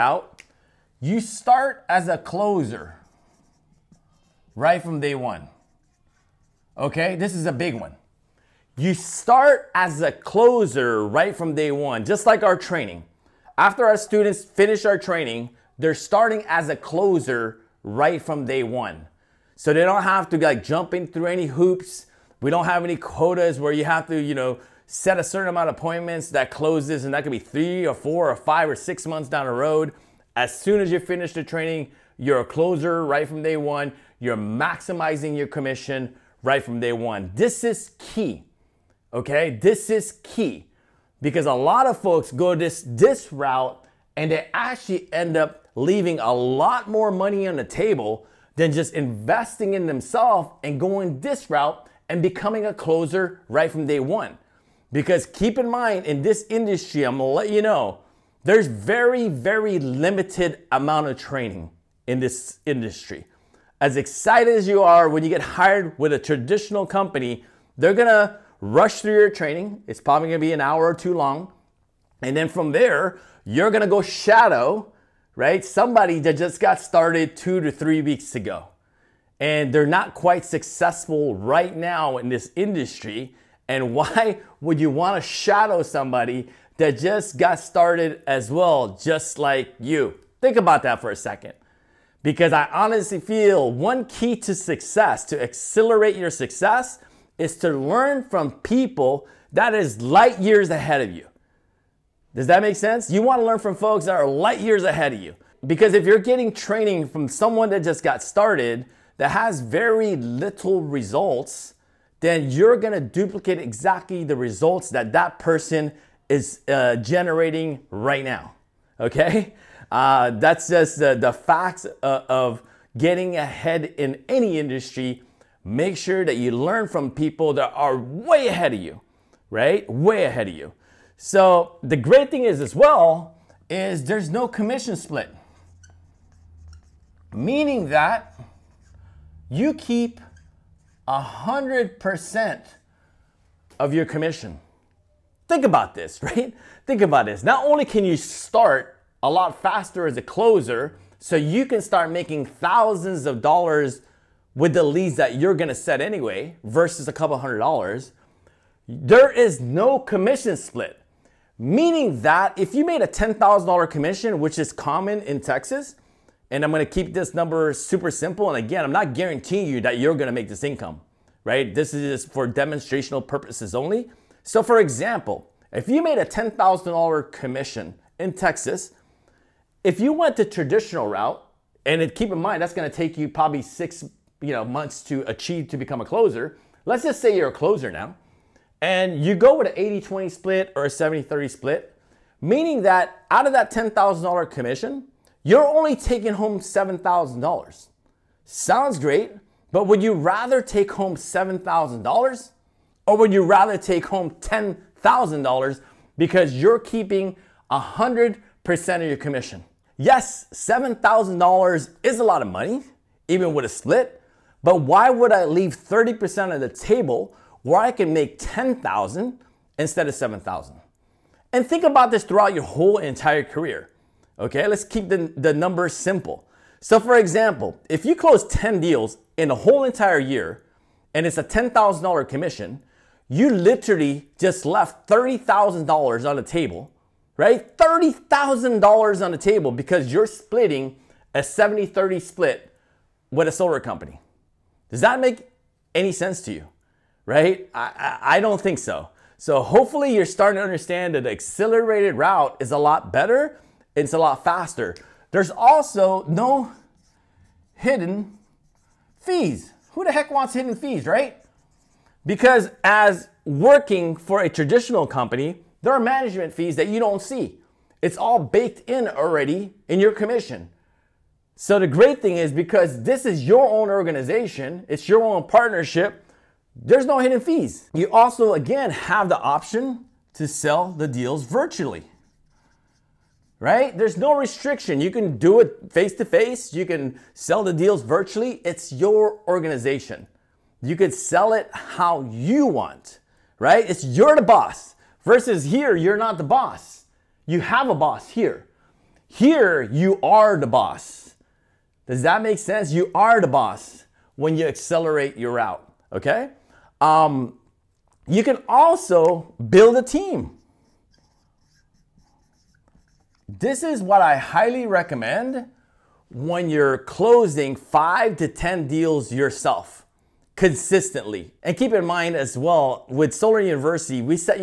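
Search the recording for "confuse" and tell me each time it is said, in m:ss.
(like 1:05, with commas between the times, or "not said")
not said.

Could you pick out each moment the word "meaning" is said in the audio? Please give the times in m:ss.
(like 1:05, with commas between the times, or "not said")
2:17, 2:41, 3:12.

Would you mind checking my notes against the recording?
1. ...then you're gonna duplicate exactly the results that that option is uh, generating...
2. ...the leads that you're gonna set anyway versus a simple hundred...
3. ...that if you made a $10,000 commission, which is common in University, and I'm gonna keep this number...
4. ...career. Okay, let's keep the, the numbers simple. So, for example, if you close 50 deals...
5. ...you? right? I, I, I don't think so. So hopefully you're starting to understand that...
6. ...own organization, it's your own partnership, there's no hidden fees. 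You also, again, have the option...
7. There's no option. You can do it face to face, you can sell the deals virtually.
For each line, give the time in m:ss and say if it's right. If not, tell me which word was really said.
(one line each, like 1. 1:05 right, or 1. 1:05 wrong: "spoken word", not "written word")
1. 1:52 wrong: "person", not "option"
2. 2:34 wrong: "couple", not "simple"
3. 2:42 wrong: "Texas", not "University"
4. 3:43 wrong: "10", not "50"
5. 4:06 right
6. 4:33 right
7. 4:43 wrong: "restriction", not "option".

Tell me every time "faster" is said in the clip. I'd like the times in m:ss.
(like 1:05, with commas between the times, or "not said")
2:29, 4:14.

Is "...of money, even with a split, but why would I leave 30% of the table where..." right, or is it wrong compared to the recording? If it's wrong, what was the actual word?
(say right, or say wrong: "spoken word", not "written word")
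right.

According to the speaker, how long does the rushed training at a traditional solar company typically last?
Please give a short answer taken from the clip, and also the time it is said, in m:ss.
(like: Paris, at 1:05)
an hour or two, at 1:10.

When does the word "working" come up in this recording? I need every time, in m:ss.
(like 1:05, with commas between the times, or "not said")
4:23.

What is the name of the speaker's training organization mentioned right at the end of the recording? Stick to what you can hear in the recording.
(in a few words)
Solar University.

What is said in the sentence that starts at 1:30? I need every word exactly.
Think about that for a second.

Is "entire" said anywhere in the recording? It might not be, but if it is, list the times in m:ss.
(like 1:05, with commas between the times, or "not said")
3:42, 3:49.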